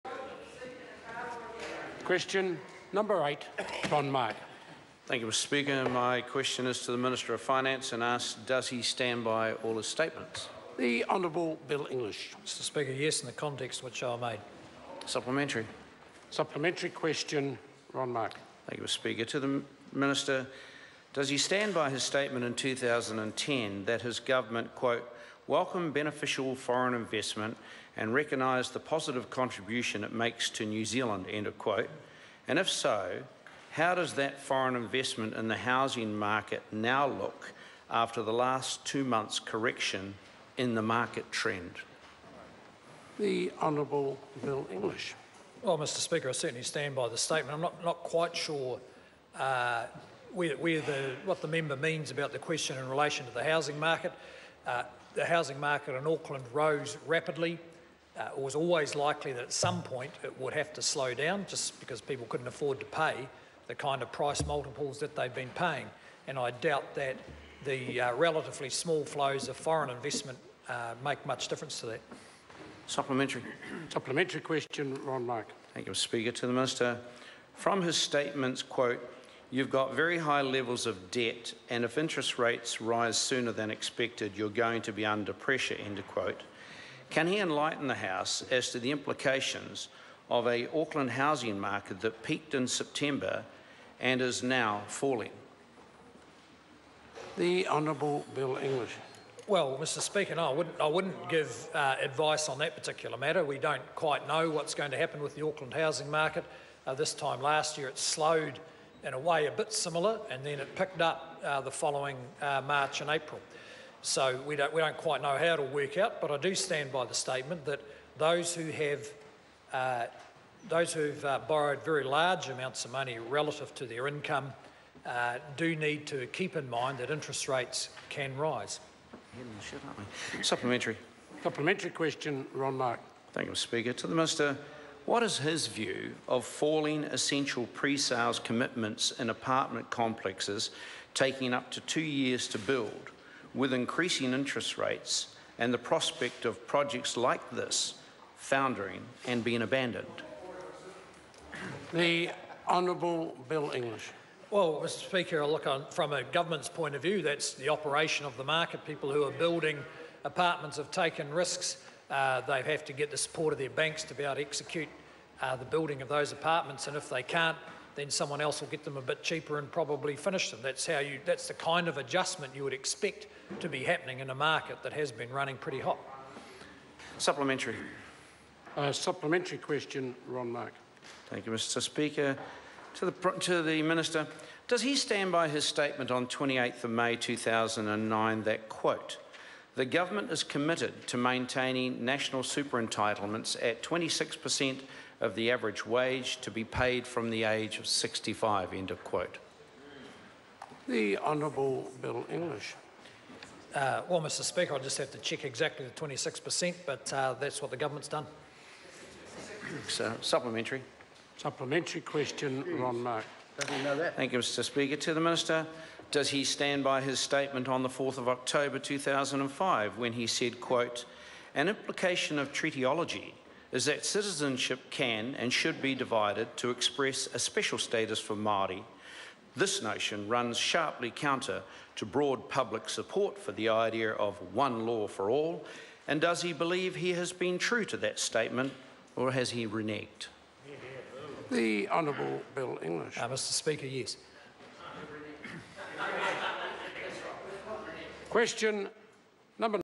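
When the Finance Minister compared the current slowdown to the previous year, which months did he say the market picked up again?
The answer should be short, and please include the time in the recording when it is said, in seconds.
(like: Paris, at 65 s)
March and April, at 112 s.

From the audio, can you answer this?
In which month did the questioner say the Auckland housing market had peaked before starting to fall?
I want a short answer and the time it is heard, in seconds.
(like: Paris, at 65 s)
September, at 92 s.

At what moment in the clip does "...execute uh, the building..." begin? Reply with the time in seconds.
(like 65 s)
164 s.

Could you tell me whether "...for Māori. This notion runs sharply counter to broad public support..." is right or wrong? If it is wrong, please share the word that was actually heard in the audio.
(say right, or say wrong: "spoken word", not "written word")
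right.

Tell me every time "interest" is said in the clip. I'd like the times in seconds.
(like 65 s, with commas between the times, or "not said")
81 s, 127 s, 144 s.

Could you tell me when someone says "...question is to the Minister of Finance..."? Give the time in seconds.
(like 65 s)
6 s.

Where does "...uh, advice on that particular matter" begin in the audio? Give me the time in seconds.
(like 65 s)
101 s.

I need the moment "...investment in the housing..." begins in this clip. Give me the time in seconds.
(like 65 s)
34 s.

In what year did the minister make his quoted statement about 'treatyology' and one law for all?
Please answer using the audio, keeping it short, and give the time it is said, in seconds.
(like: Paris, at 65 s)
2005, at 218 s.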